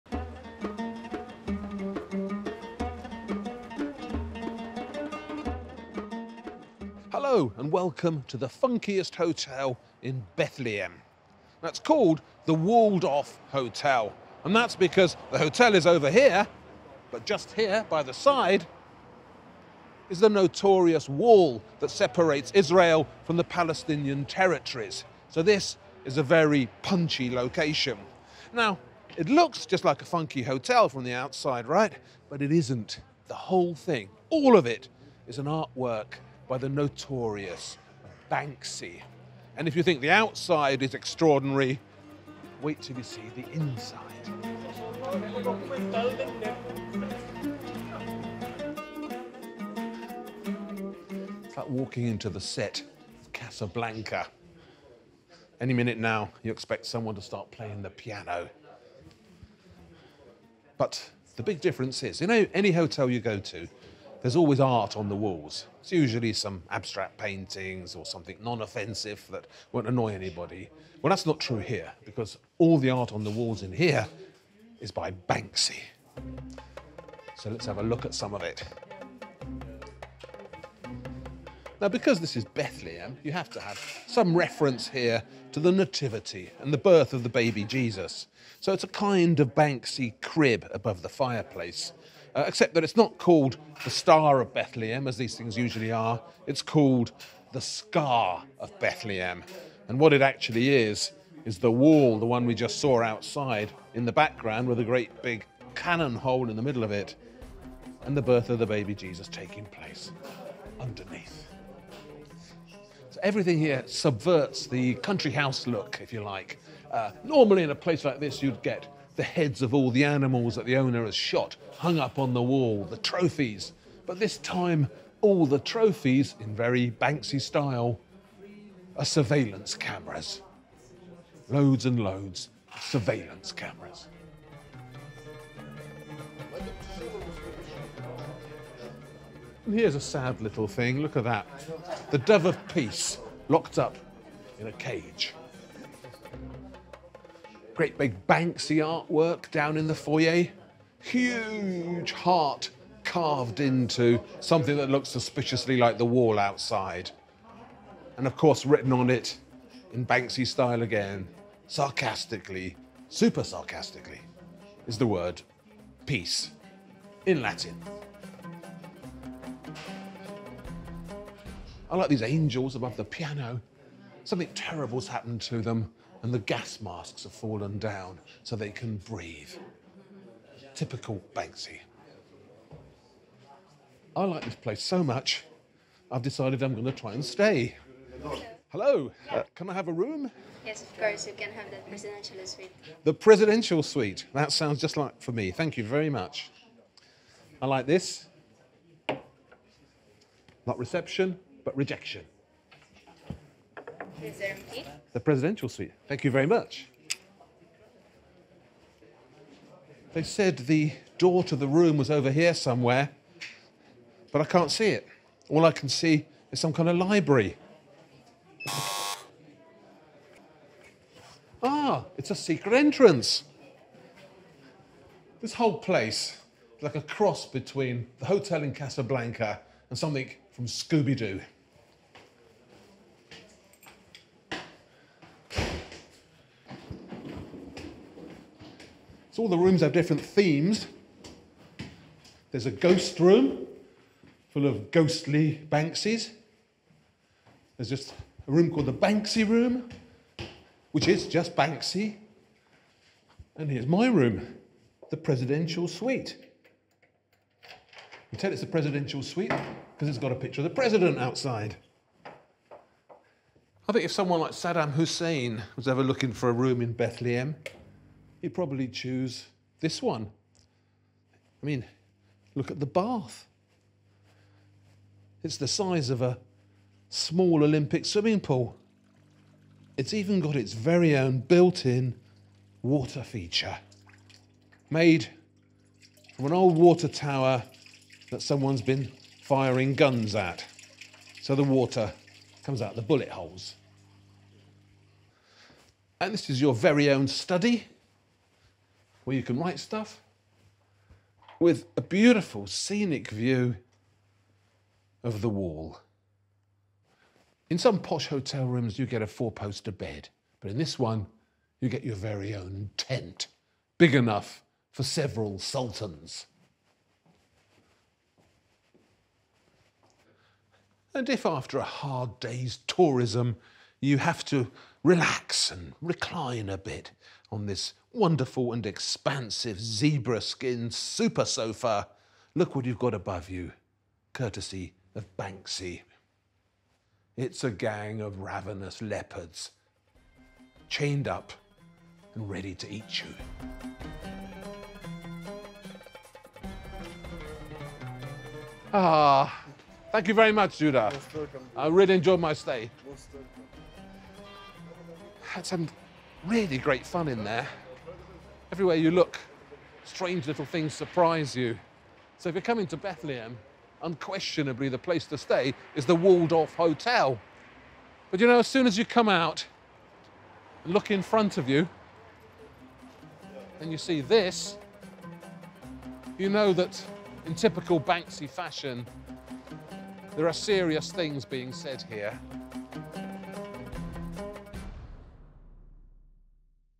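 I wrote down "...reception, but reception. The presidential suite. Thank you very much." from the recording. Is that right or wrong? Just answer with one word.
wrong.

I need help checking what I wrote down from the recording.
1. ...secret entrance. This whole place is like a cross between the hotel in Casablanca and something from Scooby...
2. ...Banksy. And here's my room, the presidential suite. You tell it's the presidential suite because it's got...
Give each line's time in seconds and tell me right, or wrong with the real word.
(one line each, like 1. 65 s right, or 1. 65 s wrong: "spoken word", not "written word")
1. 222 s right
2. 251 s right.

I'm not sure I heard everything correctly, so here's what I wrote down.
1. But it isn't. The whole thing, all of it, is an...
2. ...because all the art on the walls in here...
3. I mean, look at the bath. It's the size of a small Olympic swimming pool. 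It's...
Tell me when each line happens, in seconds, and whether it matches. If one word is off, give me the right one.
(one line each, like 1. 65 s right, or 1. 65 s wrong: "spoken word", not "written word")
1. 32 s right
2. 72 s right
3. 271 s right.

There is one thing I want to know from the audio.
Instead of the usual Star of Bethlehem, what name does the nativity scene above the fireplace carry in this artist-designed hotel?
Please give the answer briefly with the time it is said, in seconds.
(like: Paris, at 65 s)
Scar of Bethlehem, at 97 s.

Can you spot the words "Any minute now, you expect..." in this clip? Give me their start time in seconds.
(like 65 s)
55 s.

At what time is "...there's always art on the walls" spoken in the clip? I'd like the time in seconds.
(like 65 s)
64 s.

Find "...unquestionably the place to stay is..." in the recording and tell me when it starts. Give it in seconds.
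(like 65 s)
364 s.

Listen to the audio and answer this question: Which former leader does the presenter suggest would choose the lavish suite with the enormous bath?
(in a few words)
Saddam Hussein.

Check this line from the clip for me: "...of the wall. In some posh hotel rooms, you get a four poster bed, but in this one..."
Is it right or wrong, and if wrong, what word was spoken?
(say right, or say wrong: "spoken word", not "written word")
right.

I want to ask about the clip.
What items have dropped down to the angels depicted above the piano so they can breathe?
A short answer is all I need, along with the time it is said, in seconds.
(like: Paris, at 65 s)
Gas masks, at 176 s.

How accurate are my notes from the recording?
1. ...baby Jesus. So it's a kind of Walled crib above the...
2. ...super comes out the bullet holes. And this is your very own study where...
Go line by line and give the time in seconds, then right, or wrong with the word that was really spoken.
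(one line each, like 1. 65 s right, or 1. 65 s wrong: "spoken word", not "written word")
1. 87 s wrong: "Banksy", not "Walled"
2. 291 s wrong: "water", not "super".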